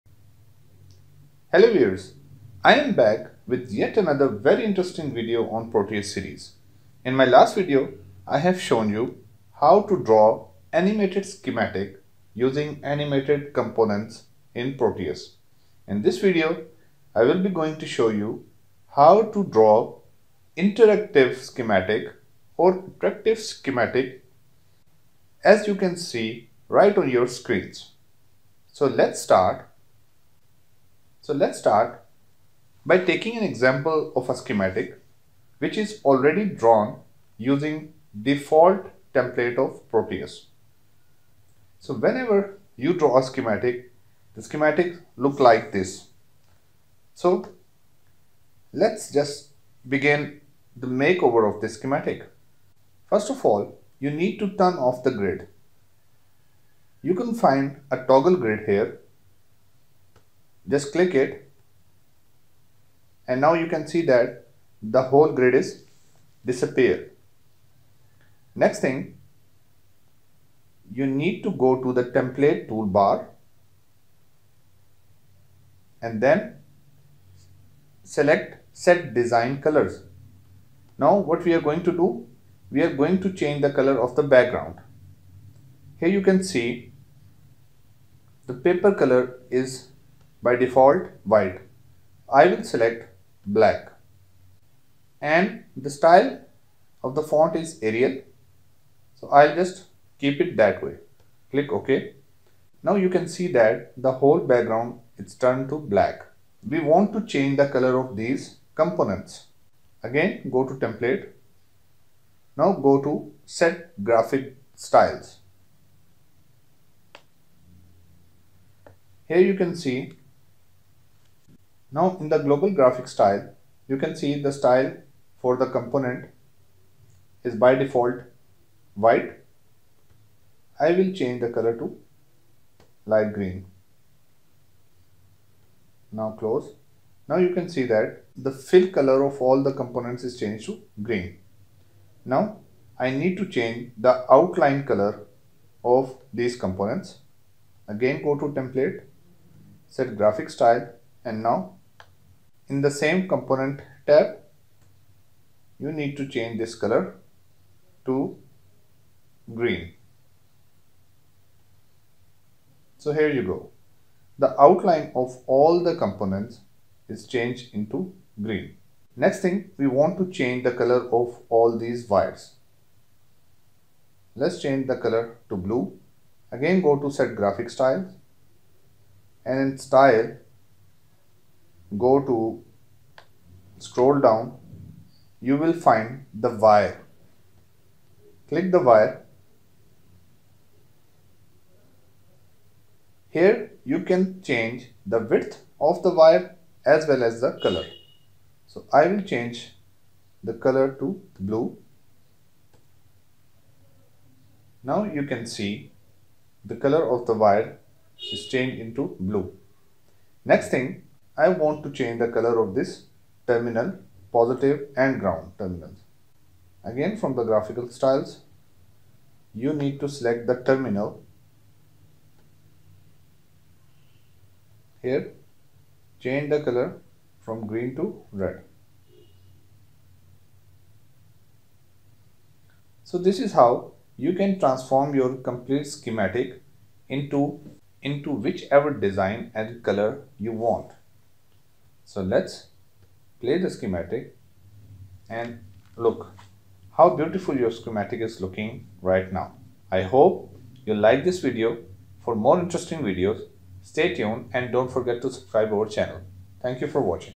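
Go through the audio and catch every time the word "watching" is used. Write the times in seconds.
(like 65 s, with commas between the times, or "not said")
257 s.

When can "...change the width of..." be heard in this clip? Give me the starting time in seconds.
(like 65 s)
194 s.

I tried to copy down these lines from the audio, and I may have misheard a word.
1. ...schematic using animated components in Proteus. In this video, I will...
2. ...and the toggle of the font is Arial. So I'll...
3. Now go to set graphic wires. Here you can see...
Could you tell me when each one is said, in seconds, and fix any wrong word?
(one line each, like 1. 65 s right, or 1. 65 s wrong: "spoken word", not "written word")
1. 11 s right
2. 95 s wrong: "style", not "toggle"
3. 112 s wrong: "styles", not "wires".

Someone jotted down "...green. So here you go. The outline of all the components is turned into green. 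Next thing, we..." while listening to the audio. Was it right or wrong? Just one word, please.
wrong.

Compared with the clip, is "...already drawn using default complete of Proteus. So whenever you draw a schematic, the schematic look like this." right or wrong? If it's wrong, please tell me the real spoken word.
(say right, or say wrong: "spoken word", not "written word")
wrong: "template", not "complete".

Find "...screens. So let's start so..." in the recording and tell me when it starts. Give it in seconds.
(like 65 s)
27 s.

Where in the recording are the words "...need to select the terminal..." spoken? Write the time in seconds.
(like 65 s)
219 s.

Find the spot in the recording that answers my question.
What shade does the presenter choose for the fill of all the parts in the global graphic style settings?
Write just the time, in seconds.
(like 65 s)
133 s.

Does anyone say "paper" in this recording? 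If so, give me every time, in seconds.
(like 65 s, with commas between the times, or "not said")
88 s.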